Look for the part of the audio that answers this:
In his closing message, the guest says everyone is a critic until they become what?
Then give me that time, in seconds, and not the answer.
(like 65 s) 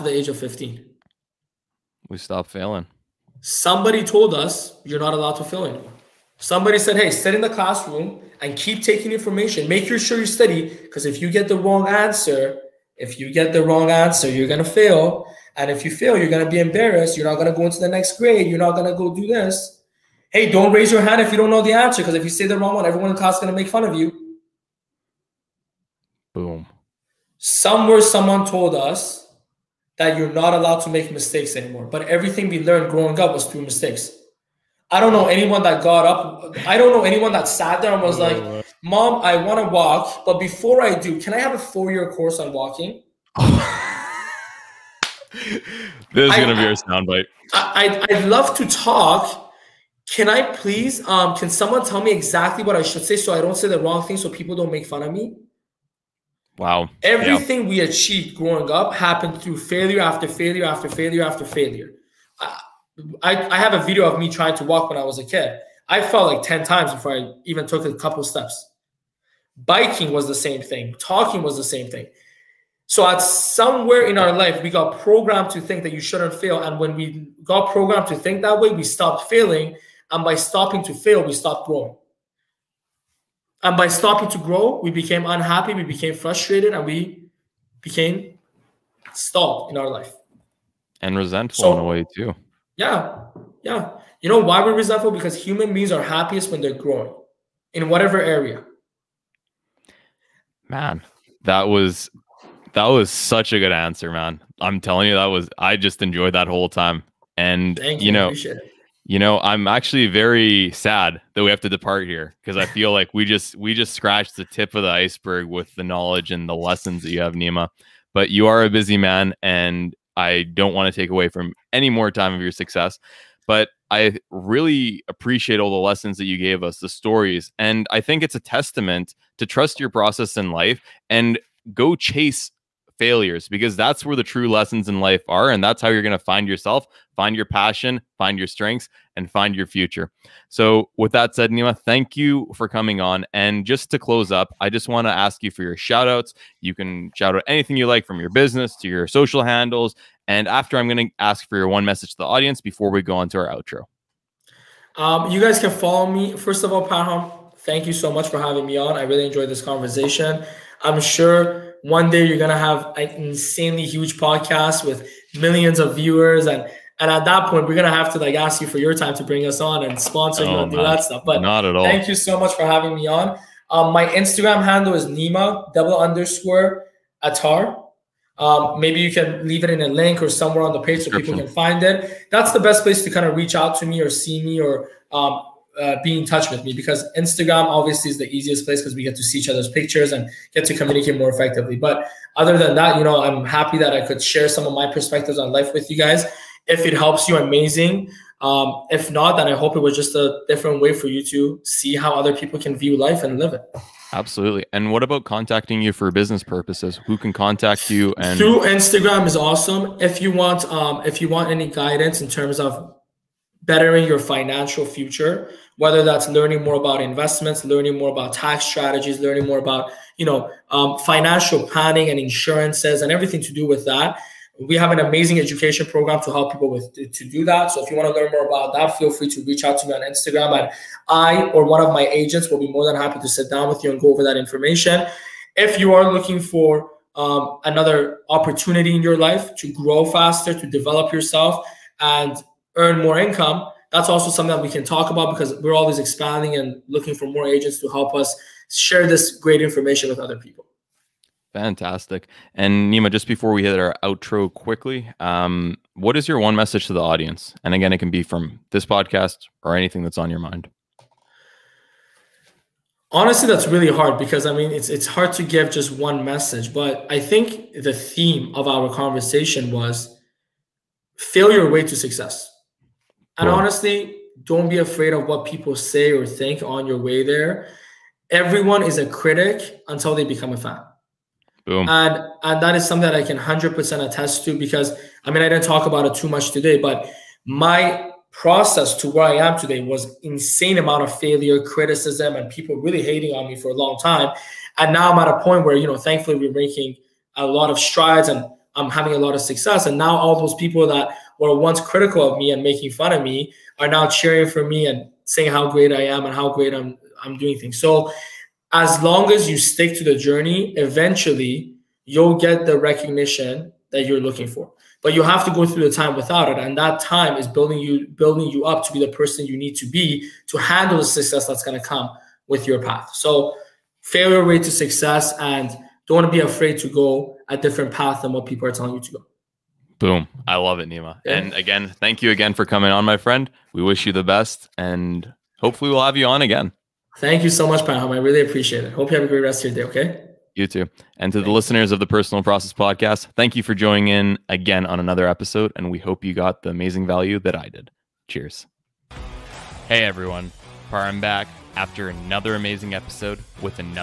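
280 s.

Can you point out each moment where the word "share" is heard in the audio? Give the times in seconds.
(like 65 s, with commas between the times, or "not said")
194 s, 248 s.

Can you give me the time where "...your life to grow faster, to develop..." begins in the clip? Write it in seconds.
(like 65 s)
239 s.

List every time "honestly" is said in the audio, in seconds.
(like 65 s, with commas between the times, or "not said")
263 s, 273 s.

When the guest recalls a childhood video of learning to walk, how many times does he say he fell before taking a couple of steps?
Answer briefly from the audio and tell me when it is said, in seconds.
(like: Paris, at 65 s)
10, at 66 s.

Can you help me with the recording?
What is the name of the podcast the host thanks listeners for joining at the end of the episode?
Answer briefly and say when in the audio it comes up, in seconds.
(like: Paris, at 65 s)
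Personal Process Podcast, at 342 s.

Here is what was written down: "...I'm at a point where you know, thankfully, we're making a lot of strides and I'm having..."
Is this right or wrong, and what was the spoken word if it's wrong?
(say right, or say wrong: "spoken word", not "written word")
right.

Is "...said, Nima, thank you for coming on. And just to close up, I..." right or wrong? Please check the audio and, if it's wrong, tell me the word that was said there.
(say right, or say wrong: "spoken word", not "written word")
right.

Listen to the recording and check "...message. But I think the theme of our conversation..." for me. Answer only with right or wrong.
right.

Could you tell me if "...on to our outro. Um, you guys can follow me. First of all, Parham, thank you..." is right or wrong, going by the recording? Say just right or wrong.
right.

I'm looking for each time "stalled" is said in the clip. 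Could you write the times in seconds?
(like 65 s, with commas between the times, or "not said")
89 s.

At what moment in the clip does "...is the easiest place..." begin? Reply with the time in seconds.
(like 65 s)
188 s.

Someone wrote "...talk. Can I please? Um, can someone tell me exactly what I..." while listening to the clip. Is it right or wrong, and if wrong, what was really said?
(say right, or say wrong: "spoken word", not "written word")
right.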